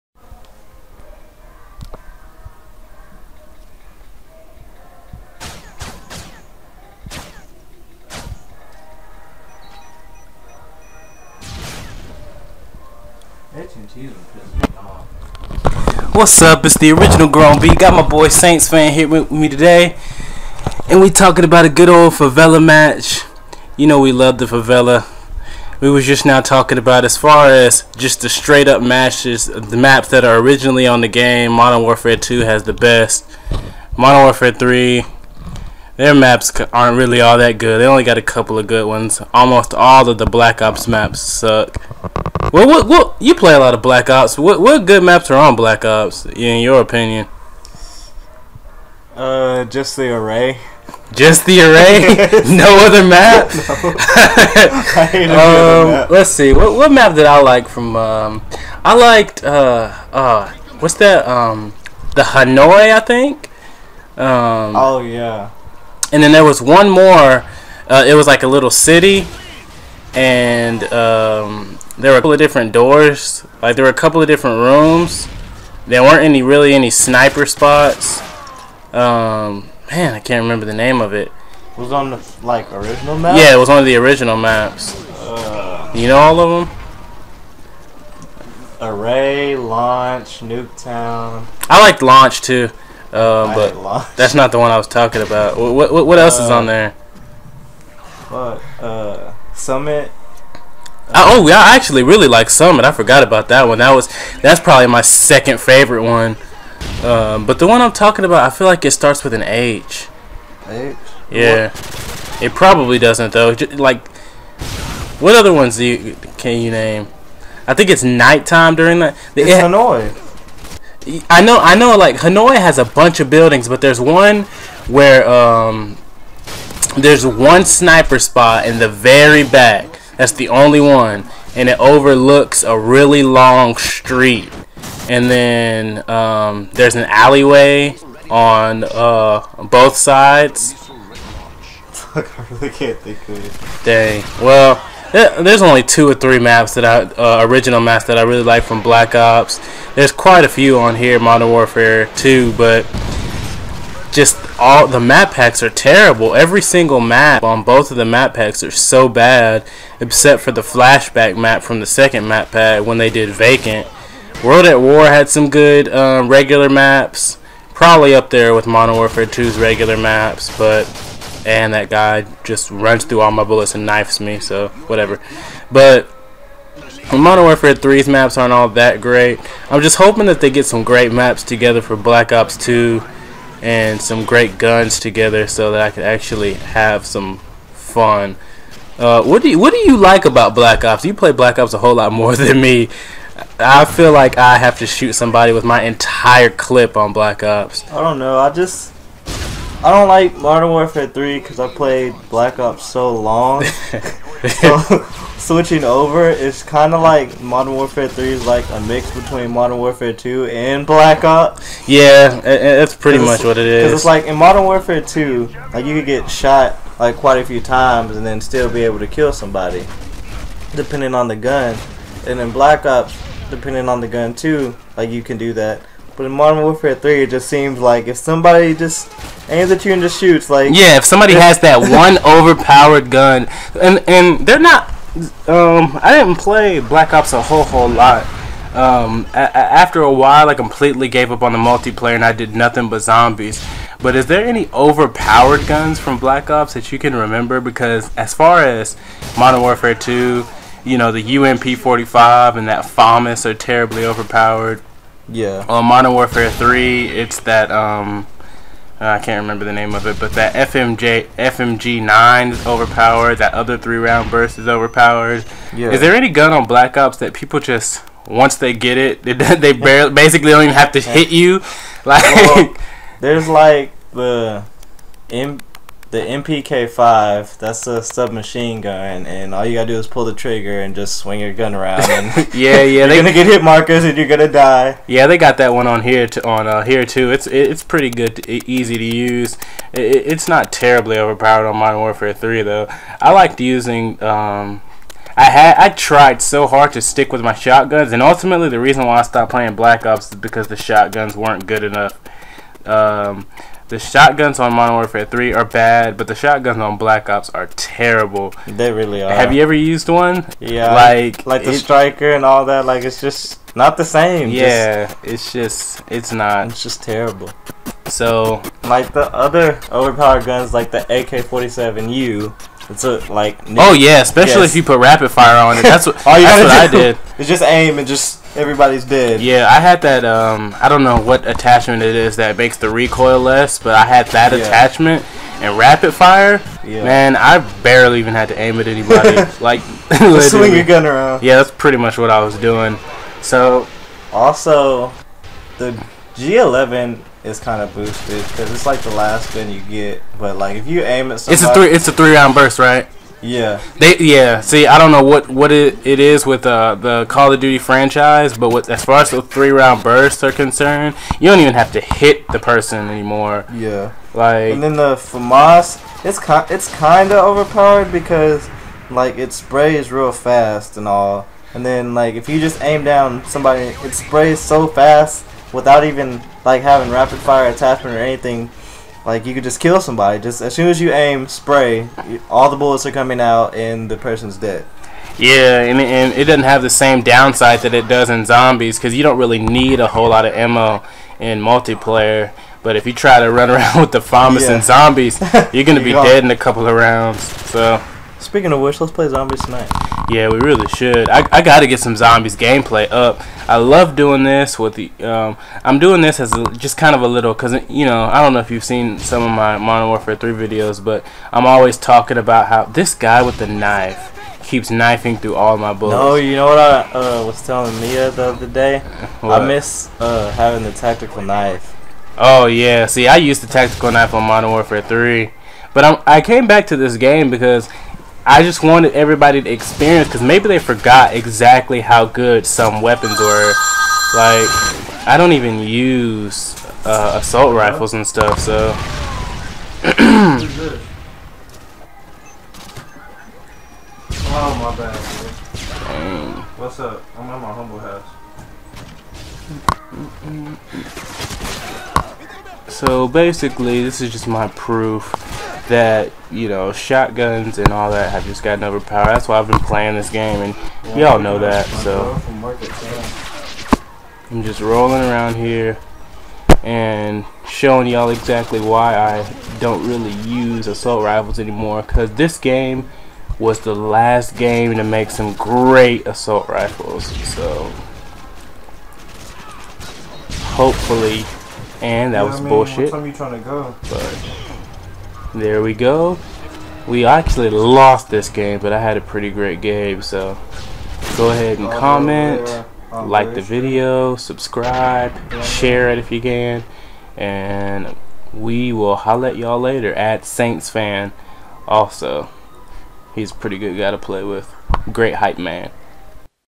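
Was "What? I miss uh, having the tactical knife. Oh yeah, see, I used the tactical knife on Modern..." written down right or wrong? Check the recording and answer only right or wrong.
right.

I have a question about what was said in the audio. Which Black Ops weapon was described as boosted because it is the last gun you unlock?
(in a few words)
G11.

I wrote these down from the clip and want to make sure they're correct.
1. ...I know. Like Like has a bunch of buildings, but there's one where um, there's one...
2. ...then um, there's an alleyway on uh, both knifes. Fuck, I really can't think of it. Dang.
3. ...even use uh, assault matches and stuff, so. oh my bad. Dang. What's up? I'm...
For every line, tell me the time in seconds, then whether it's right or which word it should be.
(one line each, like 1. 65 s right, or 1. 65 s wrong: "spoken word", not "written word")
1. 121 s wrong: "Hanoi", not "Like"
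2. 135 s wrong: "sides", not "knifes"
3. 435 s wrong: "rifles", not "matches".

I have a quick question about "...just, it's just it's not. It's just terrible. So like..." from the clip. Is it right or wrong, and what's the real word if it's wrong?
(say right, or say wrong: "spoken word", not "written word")
right.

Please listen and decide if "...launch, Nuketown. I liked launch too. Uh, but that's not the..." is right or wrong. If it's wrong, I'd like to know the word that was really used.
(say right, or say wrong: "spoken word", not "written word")
right.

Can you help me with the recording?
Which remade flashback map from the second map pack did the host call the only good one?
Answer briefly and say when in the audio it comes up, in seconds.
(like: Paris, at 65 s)
Vacant, at 163 s.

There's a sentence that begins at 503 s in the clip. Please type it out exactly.
He's a pretty good guy to play with.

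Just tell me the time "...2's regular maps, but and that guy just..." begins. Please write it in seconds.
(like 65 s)
169 s.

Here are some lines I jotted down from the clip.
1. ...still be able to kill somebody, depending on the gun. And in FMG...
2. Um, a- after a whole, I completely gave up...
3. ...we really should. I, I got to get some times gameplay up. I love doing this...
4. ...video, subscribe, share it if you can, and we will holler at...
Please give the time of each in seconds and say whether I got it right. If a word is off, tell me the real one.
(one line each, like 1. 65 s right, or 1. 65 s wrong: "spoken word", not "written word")
1. 218 s wrong: "Black", not "FMG"
2. 238 s wrong: "while", not "whole"
3. 400 s wrong: "zombies", not "times"
4. 493 s right.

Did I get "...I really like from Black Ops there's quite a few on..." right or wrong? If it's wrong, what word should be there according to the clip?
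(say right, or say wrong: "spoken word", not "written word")
right.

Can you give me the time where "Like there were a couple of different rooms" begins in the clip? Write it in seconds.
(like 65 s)
73 s.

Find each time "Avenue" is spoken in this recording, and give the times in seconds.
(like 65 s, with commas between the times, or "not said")
not said.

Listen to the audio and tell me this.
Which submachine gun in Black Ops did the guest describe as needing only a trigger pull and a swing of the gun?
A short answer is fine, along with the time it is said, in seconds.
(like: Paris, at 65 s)
MPK5, at 276 s.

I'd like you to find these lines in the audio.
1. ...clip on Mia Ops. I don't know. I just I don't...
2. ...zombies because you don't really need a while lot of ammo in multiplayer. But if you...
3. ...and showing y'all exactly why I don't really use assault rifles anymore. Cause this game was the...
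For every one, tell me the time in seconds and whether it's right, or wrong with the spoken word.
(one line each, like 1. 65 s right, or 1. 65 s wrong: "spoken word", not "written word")
1. 196 s wrong: "Black", not "Mia"
2. 388 s wrong: "whole", not "while"
3. 466 s right.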